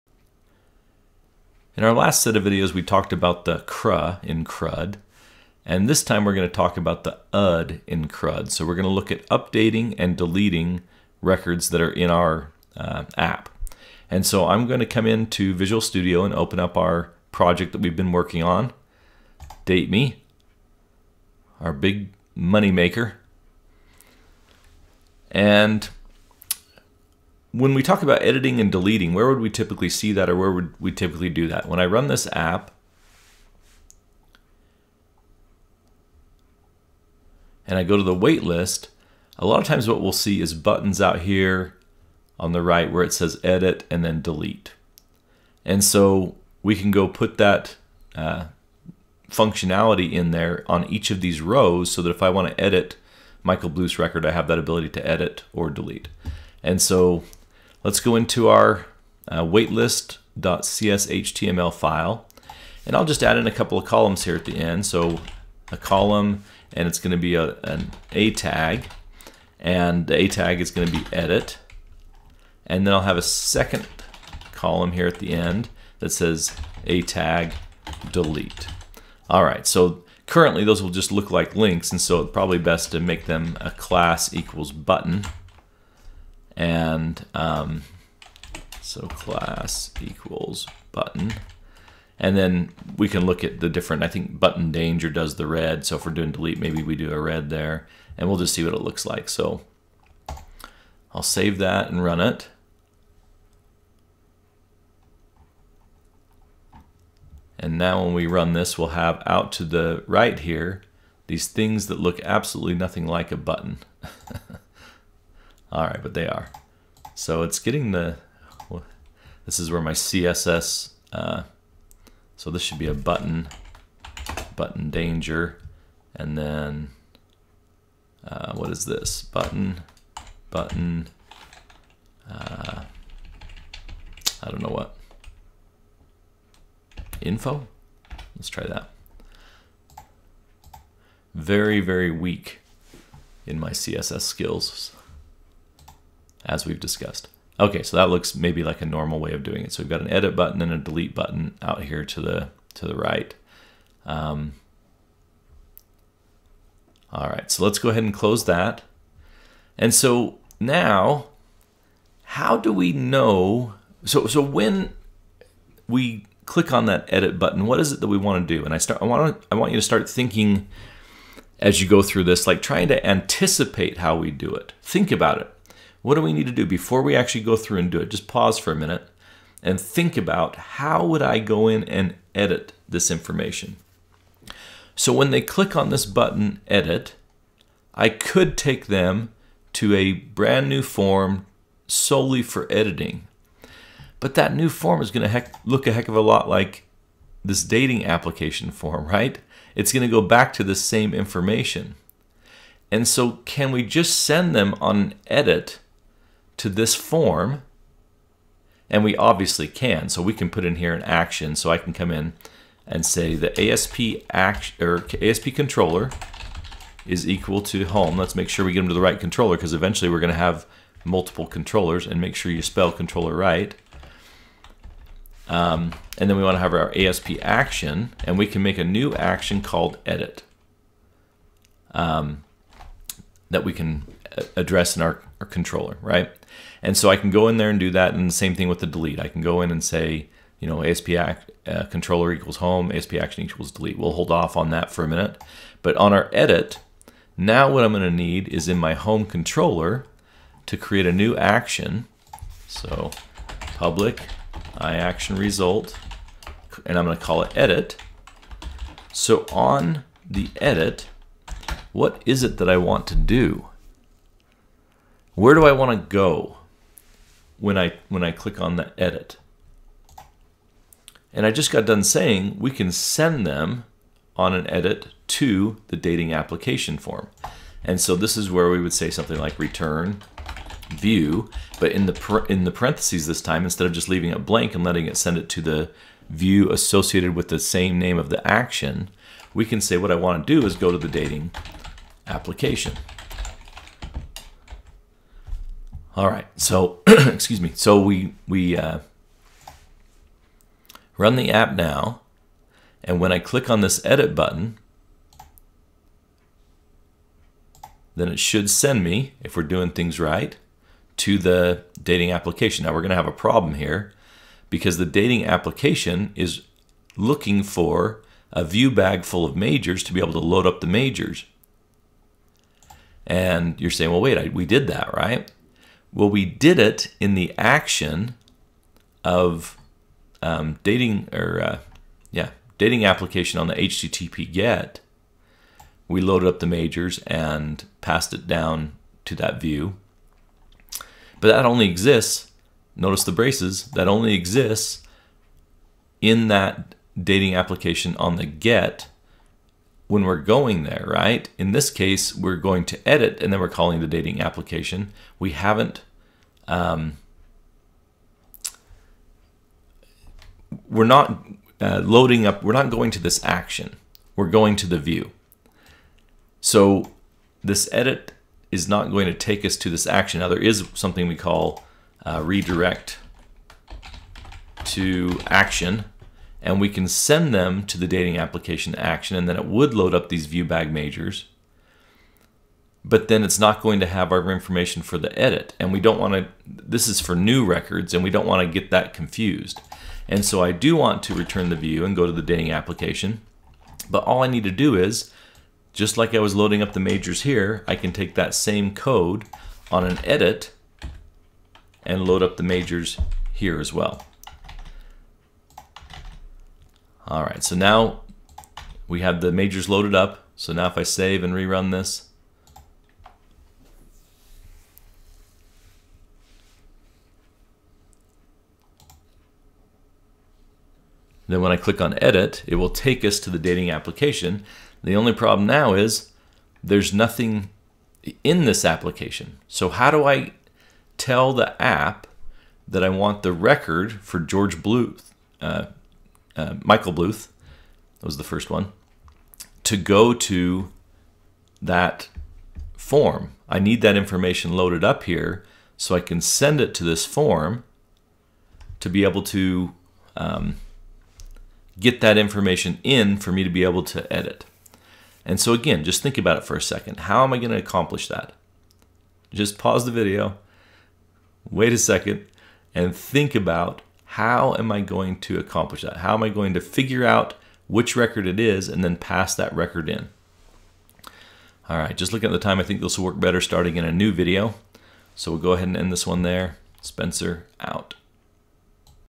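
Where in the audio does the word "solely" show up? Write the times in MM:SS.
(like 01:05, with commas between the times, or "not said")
03:11.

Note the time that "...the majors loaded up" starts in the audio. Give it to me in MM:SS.
06:49.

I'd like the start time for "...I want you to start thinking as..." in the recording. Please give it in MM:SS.
02:49.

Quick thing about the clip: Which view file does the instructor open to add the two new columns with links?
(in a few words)
waitlist.cshtml.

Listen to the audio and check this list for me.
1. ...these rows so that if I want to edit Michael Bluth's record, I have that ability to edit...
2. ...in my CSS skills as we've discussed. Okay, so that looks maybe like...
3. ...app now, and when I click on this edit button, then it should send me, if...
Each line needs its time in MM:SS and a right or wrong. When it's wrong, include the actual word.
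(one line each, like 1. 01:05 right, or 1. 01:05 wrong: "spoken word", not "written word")
1. 00:51 right
2. 02:23 right
3. 05:01 right.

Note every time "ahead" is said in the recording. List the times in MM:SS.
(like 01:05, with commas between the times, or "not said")
02:37, 07:55.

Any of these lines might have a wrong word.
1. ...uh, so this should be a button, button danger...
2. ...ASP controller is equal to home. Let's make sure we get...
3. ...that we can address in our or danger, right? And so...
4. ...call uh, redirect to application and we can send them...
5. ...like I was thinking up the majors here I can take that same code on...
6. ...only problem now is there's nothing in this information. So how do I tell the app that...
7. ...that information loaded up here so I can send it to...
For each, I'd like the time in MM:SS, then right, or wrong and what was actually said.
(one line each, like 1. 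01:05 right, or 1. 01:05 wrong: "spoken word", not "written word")
1. 02:01 right
2. 03:35 right
3. 03:53 wrong: "controller", not "danger"
4. 06:11 wrong: "action", not "application"
5. 06:36 wrong: "loading", not "thinking"
6. 07:05 wrong: "application", not "information"
7. 07:24 right.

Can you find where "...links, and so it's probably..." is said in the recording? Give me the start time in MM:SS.
01:21.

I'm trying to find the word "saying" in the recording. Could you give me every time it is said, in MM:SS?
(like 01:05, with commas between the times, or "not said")
04:32, 05:23.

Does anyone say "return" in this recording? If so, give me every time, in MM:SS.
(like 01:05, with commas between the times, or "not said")
04:39, 06:31.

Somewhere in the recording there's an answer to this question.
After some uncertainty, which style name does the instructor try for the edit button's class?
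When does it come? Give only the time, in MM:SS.
02:17.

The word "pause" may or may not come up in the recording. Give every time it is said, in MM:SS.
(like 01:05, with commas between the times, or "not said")
02:58, 07:39.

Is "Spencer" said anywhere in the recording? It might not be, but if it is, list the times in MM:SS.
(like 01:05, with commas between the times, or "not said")
07:57.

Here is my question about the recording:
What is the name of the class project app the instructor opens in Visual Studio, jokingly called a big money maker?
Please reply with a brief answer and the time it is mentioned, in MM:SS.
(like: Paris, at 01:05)
Date Me, at 00:19.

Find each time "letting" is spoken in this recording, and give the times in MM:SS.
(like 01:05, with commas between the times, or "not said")
04:44.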